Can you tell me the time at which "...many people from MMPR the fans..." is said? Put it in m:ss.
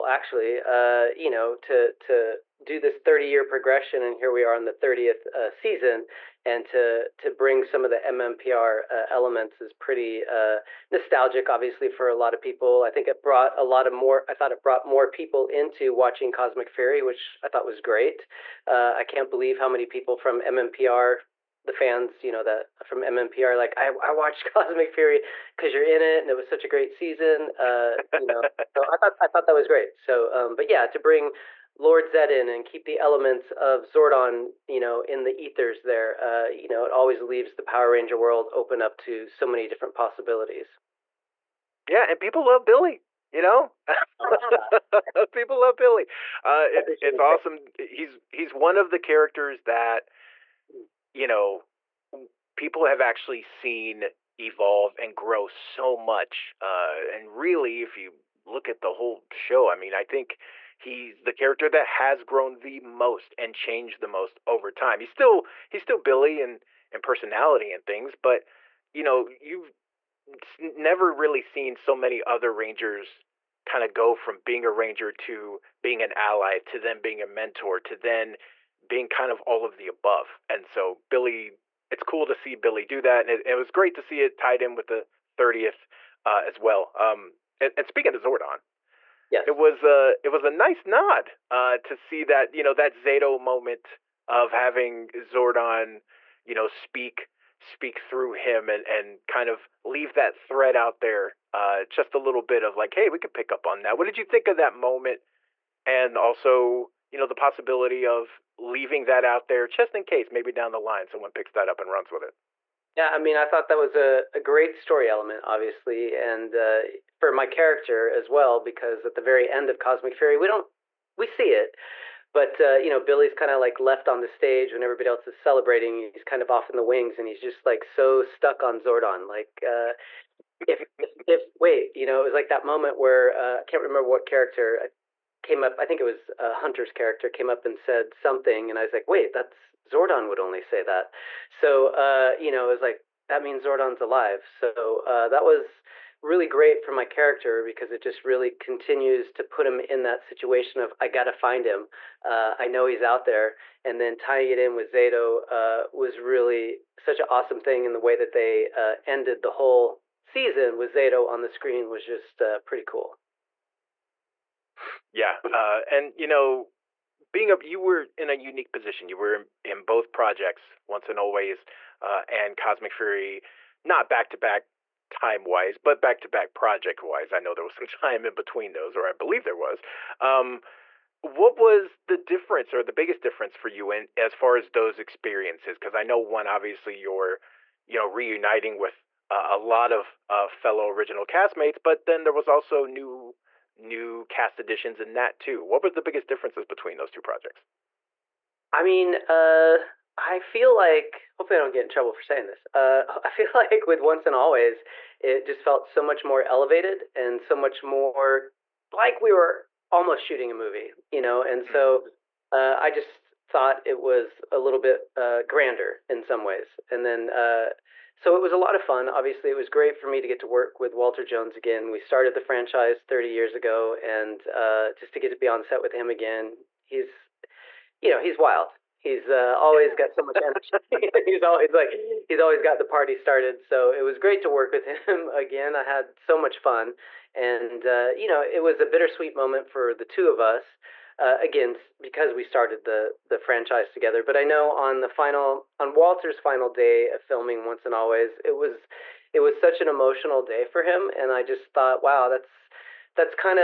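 0:19.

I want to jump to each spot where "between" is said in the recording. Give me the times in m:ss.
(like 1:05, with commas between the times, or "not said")
2:58, 3:16.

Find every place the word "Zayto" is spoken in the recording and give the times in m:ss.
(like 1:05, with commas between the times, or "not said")
1:32, 2:34, 2:40.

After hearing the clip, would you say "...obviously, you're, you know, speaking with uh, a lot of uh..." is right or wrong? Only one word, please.
wrong.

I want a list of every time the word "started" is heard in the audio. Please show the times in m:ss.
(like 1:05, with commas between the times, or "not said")
3:41, 3:53, 4:02.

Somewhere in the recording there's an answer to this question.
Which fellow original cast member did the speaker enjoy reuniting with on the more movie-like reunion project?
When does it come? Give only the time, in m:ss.
3:40.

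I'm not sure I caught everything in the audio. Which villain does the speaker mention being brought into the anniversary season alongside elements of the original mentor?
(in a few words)
Lord Zed.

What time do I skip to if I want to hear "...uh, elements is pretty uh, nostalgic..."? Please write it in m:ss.
0:08.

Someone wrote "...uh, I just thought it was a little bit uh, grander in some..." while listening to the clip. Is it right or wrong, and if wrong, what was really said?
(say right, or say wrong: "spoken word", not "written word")
right.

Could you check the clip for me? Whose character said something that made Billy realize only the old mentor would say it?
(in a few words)
Hunter.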